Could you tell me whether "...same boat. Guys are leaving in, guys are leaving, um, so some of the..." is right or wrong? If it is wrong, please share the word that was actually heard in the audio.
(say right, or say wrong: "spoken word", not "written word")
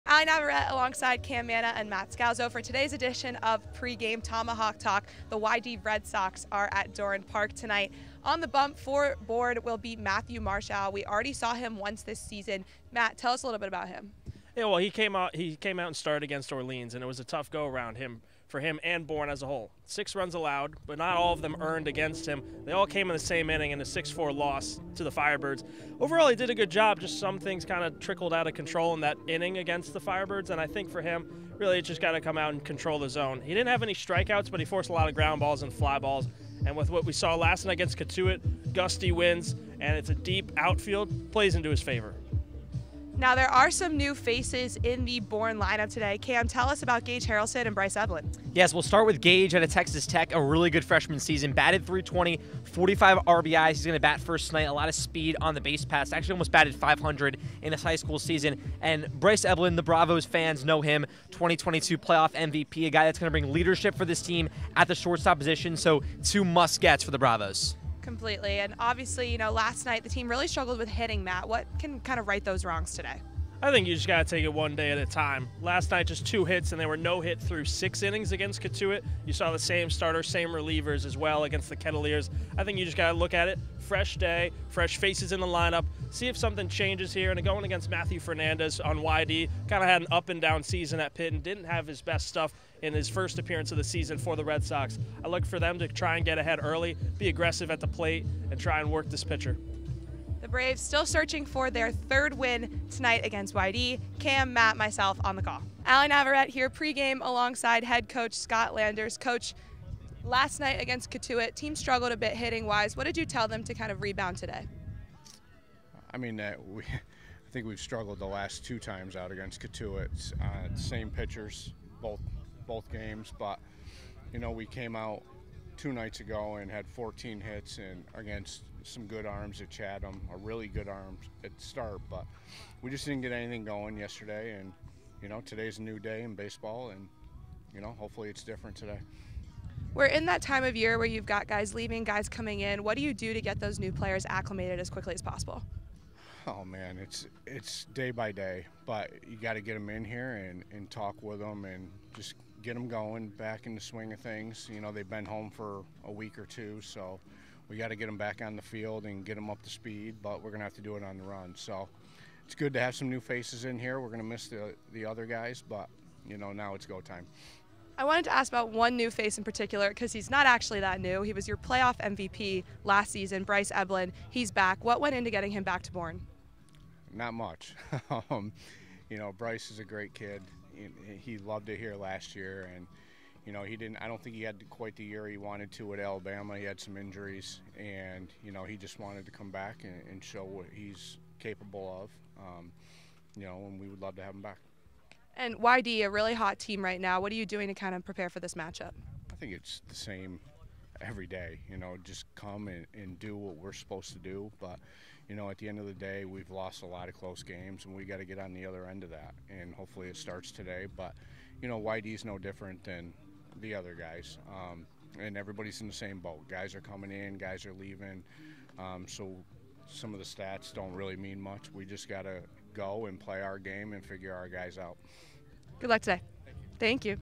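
wrong: "coming", not "leaving".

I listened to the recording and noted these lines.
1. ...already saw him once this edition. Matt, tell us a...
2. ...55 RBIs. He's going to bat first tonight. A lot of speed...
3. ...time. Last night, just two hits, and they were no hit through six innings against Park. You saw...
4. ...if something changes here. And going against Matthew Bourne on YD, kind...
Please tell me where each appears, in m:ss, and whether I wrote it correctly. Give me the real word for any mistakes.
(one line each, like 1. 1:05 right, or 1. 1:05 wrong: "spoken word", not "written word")
1. 0:11 wrong: "season", not "edition"
2. 0:52 wrong: "45", not "55"
3. 1:15 wrong: "Cotuit", not "Park"
4. 1:26 wrong: "Fernandez", not "Bourne".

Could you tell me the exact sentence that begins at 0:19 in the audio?
Six runs allowed, but not all of them earned against him.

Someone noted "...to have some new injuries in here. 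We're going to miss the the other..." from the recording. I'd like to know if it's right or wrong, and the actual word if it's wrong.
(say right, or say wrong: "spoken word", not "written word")
wrong: "faces", not "injuries".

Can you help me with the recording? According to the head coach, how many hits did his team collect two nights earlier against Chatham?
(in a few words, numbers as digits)
14.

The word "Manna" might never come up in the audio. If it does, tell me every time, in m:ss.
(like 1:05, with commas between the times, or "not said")
0:01.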